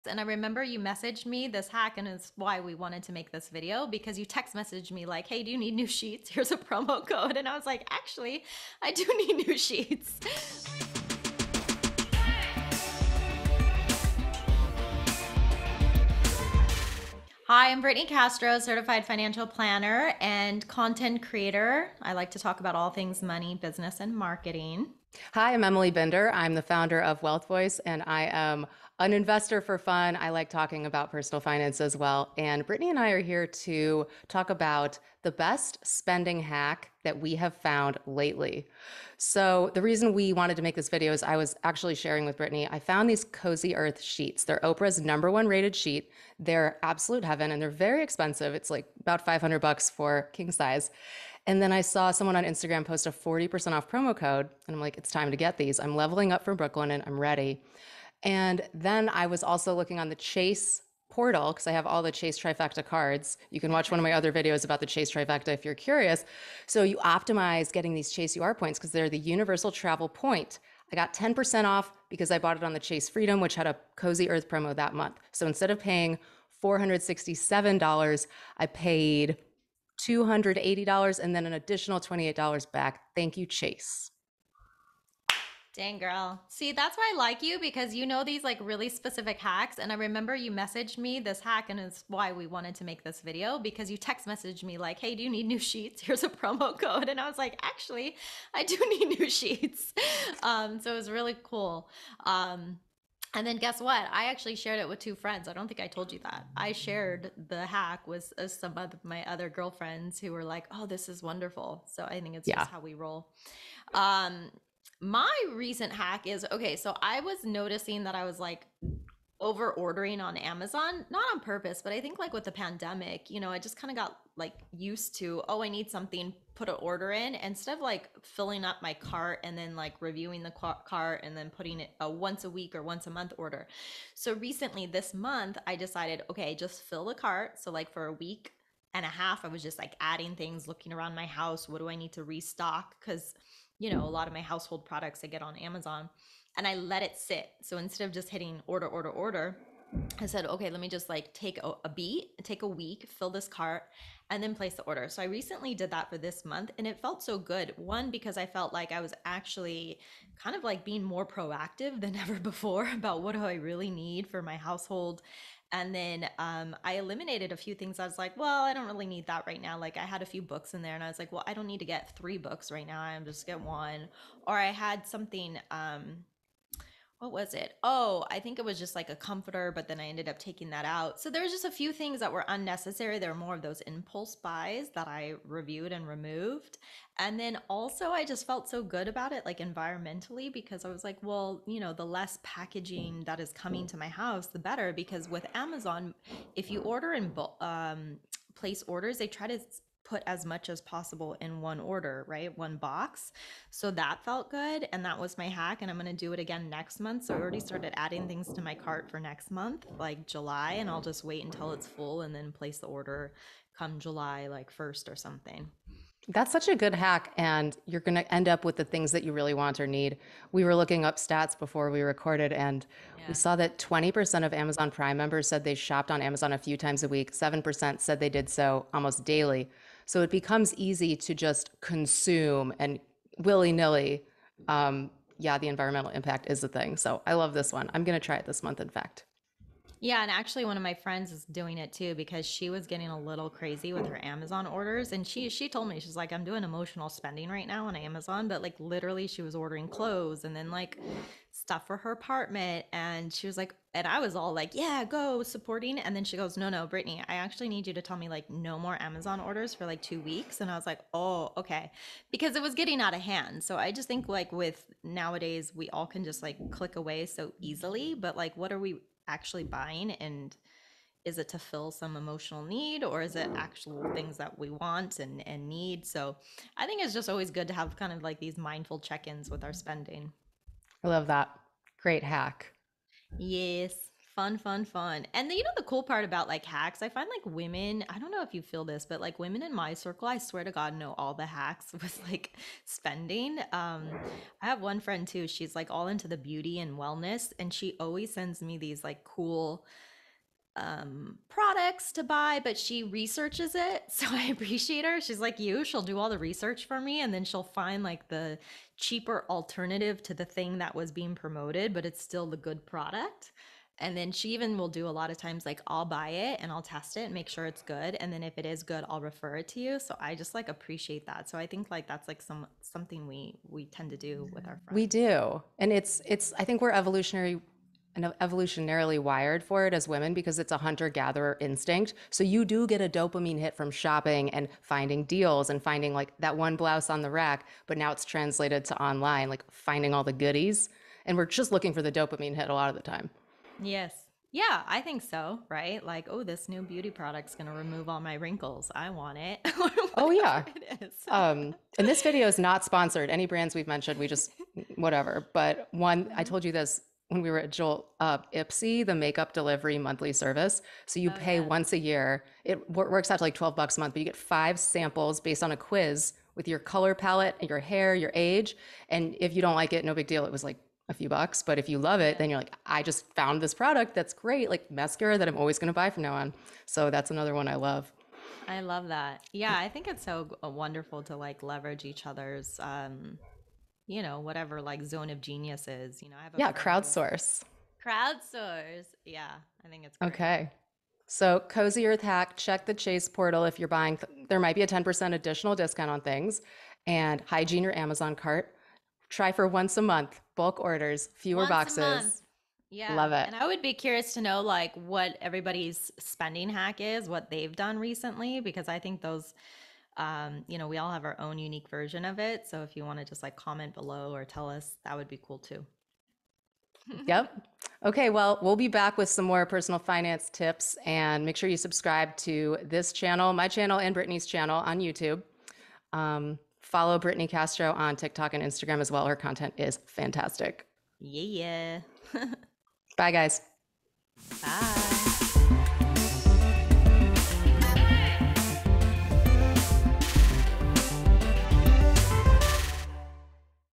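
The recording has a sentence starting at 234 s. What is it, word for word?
Um, yeah, the environmental impact is a thing.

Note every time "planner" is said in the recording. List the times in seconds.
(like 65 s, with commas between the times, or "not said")
19 s.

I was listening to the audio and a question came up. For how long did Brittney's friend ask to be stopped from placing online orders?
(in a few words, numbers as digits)
2 weeks.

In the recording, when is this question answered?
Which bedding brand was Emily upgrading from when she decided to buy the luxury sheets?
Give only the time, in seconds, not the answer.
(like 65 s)
56 s.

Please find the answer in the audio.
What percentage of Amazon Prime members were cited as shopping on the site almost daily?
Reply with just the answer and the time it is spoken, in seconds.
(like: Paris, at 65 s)
7%, at 227 s.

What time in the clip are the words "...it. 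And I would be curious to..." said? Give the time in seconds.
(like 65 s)
403 s.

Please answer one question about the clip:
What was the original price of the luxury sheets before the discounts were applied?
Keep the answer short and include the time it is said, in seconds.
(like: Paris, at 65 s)
$467, at 76 s.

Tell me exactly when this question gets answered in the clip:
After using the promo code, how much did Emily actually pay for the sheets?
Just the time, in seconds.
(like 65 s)
80 s.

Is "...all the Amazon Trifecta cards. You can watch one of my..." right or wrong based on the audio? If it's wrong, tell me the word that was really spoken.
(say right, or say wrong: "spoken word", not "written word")
wrong: "Chase", not "Amazon".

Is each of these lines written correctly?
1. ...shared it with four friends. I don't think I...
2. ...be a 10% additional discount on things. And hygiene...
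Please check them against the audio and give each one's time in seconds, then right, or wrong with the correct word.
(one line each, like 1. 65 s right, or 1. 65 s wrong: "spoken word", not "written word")
1. 104 s wrong: "two", not "four"
2. 394 s right.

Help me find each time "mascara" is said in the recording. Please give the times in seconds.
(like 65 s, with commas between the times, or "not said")
374 s.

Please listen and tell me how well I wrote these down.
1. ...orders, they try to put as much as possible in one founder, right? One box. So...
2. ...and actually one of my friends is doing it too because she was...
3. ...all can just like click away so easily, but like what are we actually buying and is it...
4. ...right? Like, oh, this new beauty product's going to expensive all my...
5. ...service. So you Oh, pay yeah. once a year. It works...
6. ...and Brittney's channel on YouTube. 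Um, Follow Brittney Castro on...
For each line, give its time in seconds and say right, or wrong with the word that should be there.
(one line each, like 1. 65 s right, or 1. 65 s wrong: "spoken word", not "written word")
1. 198 s wrong: "order", not "founder"
2. 240 s right
3. 265 s right
4. 345 s wrong: "remove", not "expensive"
5. 360 s right
6. 424 s right.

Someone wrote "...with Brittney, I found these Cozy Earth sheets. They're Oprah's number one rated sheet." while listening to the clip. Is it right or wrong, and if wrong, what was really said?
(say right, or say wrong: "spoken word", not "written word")
right.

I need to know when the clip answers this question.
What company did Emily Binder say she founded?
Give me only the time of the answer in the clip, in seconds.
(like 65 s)
27 s.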